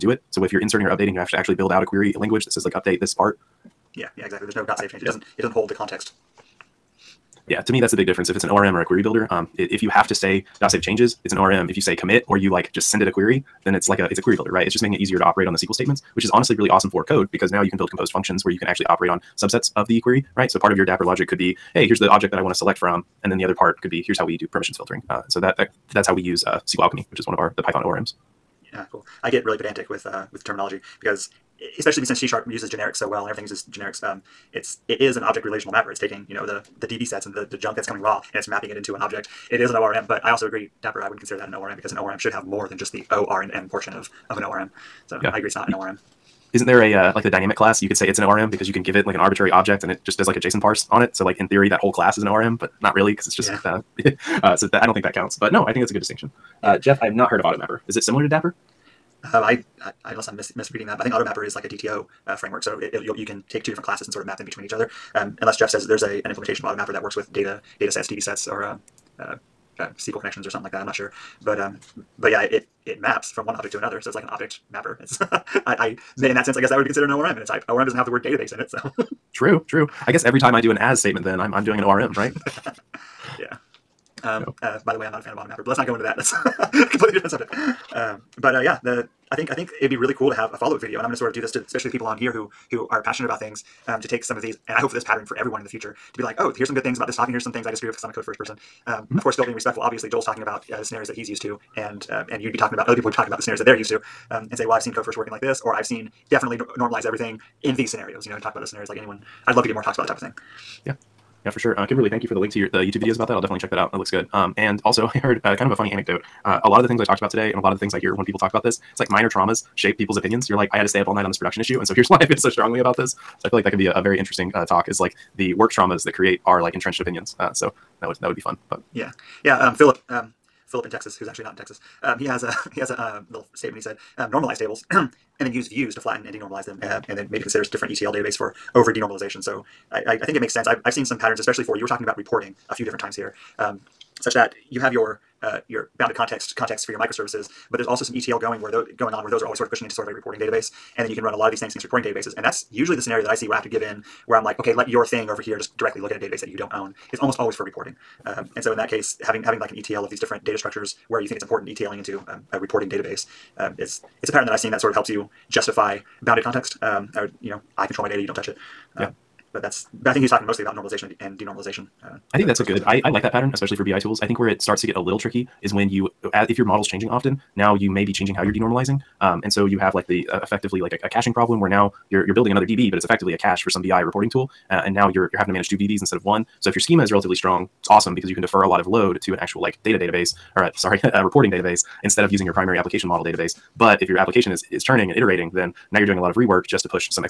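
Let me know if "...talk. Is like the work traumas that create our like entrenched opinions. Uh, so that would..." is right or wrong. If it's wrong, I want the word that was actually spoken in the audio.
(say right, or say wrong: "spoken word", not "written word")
right.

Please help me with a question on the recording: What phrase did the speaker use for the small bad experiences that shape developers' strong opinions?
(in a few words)
minor traumas.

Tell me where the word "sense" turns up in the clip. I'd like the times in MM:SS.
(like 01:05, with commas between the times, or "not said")
01:16, 02:20.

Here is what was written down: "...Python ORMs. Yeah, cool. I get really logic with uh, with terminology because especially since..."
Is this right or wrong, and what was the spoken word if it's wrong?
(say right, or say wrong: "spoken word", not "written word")
wrong: "pedantic", not "logic".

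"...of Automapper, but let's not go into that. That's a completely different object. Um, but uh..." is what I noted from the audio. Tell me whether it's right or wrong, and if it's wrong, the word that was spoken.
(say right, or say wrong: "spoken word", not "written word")
wrong: "subject", not "object".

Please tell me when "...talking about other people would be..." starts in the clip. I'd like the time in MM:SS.
01:42.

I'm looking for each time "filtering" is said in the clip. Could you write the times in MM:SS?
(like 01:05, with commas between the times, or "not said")
00:24.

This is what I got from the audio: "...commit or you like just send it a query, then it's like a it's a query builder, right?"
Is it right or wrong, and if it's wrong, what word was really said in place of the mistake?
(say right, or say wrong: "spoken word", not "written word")
right.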